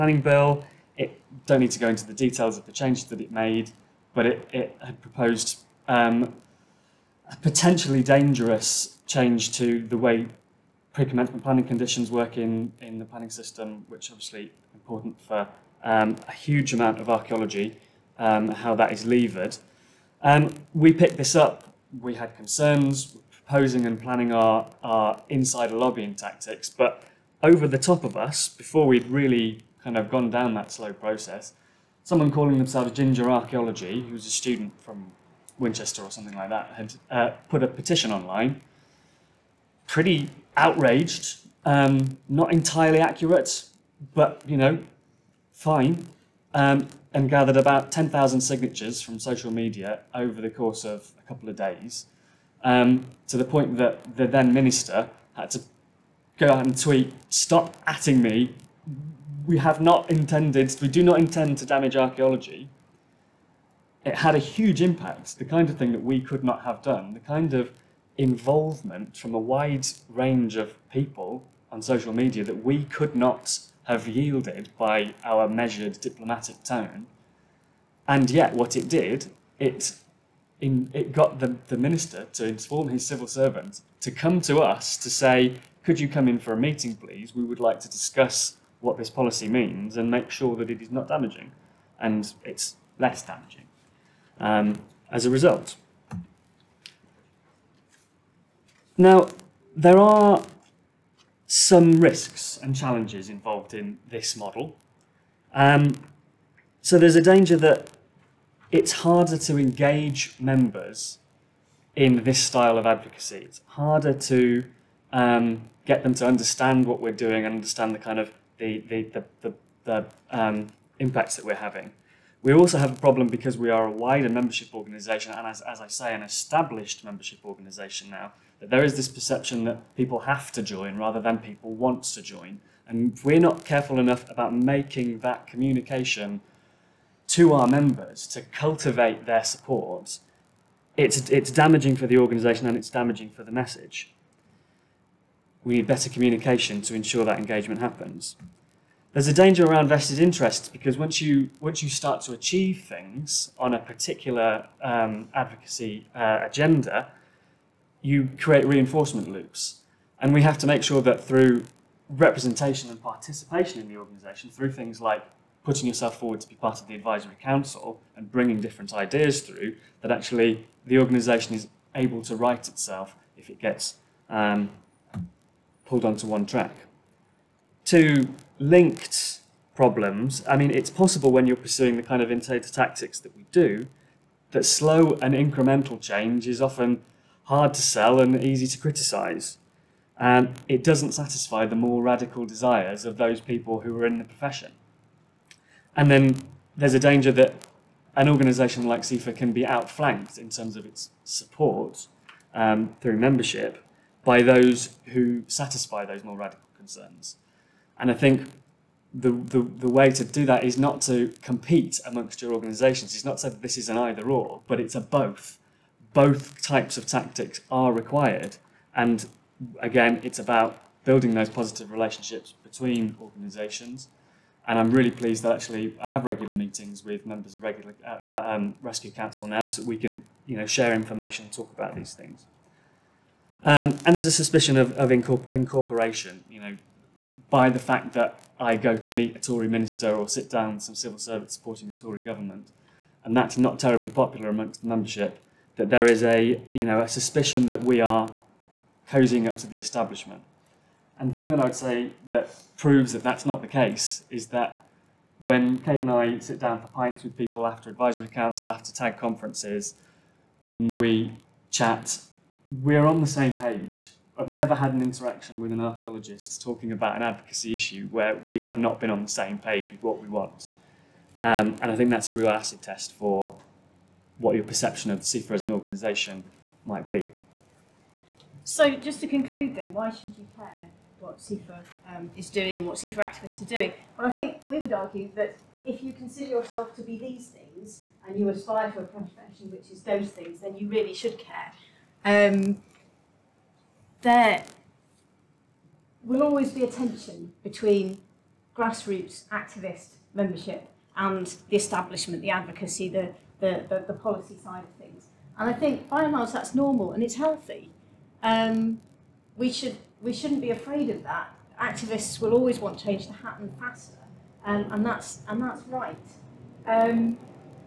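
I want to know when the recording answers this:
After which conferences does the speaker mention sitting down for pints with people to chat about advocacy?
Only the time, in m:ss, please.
4:18.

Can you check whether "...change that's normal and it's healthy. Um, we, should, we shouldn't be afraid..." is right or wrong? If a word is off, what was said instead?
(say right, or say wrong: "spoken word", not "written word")
wrong: "large", not "change".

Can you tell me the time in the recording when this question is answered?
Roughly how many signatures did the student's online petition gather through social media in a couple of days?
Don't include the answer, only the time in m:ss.
0:47.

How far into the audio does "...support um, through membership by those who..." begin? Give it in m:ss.
3:21.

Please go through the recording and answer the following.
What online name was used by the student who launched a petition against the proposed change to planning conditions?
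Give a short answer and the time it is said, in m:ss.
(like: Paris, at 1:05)
Ginger Archaeology, at 0:32.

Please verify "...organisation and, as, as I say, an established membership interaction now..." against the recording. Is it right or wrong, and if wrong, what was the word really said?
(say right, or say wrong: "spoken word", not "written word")
wrong: "organisation", not "interaction".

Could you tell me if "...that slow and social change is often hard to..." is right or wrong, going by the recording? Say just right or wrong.
wrong.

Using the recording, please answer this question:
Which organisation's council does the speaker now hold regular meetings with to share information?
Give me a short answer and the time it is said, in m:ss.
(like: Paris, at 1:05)
Rescue, at 3:48.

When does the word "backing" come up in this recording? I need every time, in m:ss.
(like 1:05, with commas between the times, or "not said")
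not said.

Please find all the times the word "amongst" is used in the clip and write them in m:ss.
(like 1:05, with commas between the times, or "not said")
3:32, 4:04.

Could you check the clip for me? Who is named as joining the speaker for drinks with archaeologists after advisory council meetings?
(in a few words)
Kate.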